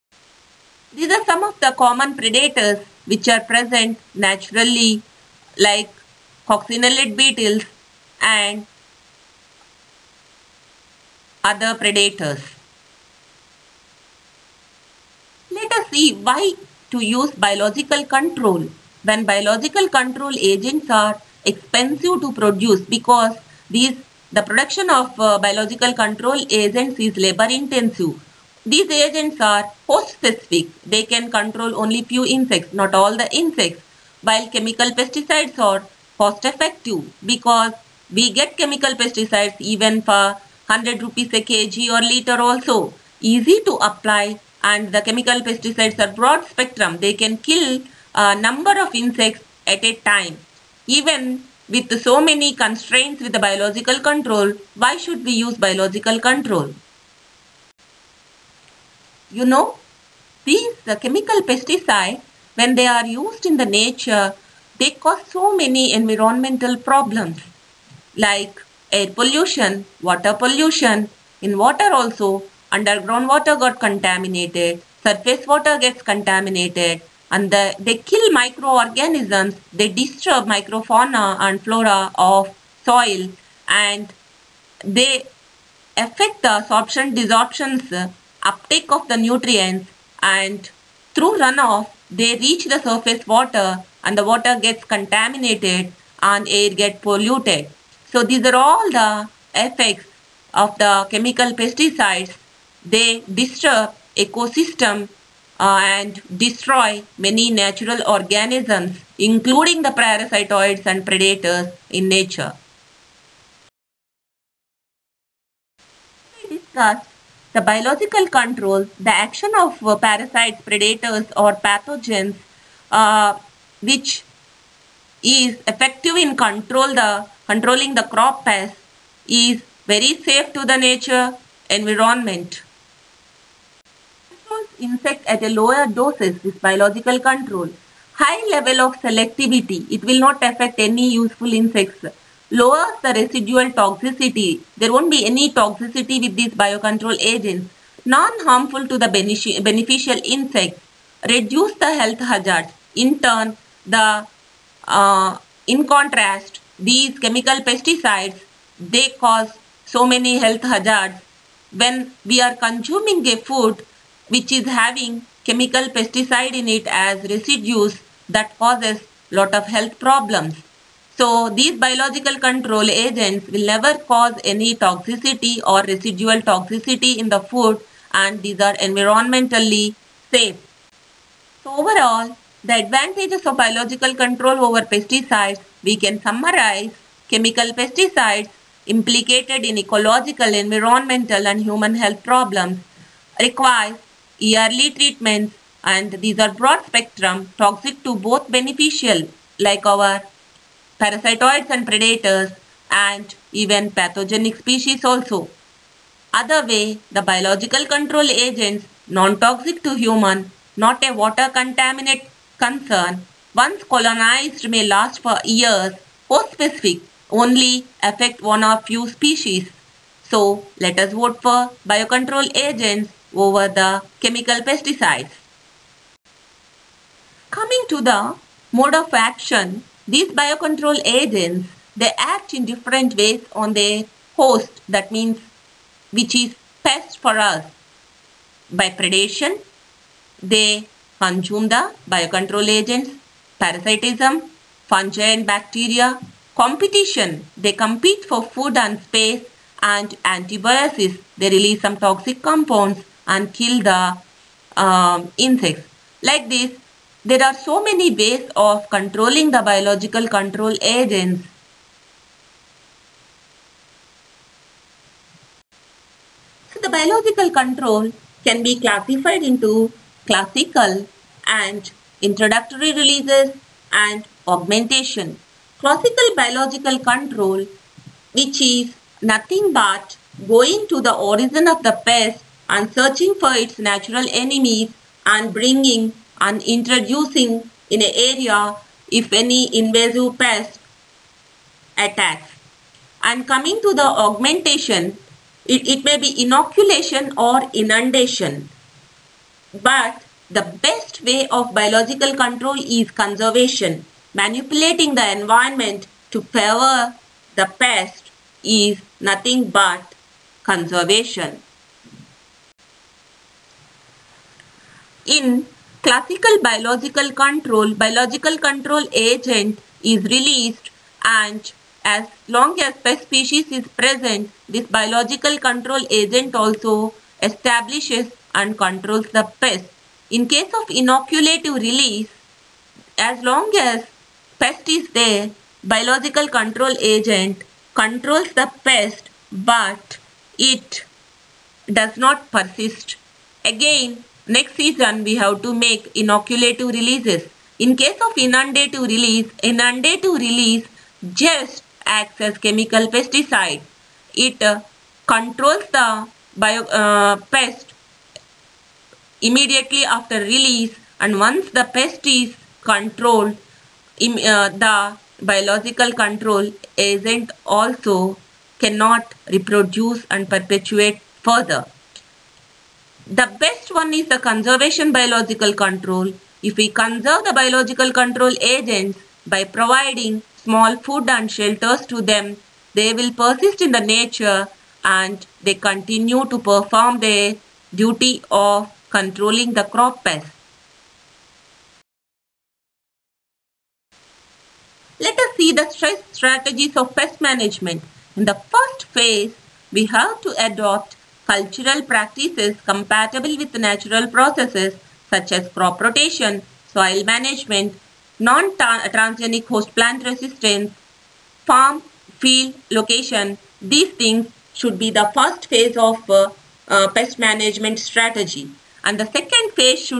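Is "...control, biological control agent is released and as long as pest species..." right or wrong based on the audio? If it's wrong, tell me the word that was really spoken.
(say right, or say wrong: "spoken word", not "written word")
right.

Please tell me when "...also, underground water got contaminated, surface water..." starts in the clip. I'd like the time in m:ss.
1:11.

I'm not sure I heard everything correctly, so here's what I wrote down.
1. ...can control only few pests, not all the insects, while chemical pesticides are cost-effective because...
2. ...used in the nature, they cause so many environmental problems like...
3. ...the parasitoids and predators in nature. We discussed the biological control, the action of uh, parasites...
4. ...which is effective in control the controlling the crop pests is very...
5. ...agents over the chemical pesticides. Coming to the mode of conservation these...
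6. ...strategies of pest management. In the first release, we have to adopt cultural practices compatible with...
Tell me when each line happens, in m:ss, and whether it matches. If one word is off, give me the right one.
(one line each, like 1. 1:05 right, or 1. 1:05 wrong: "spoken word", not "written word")
1. 0:31 wrong: "insects", not "pests"
2. 1:03 right
3. 1:49 right
4. 2:03 right
5. 3:42 wrong: "action", not "conservation"
6. 6:36 wrong: "phase", not "release".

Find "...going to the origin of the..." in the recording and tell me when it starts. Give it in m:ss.
4:40.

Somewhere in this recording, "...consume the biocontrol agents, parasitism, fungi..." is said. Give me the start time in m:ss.
4:01.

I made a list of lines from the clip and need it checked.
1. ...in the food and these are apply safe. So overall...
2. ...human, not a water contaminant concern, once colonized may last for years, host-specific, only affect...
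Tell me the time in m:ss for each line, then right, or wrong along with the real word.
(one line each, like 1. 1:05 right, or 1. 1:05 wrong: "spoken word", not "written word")
1. 2:57 wrong: "environmentally", not "apply"
2. 3:29 right.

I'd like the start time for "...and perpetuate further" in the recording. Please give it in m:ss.
6:10.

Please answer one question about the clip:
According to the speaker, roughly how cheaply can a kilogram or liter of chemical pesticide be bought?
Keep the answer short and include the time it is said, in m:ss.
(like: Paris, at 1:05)
100 rupees, at 0:40.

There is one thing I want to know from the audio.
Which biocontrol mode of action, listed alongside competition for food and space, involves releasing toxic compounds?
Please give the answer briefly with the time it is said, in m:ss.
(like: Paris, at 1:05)
antibiotics, at 4:10.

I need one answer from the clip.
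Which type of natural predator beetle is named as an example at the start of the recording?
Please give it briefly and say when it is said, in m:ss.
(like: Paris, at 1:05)
coccinellid beetles, at 0:06.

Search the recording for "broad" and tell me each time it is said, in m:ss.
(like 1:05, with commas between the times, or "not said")
0:46, 3:16.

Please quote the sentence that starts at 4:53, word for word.
And coming to the augmentation, it, it may be inoculation or inundation.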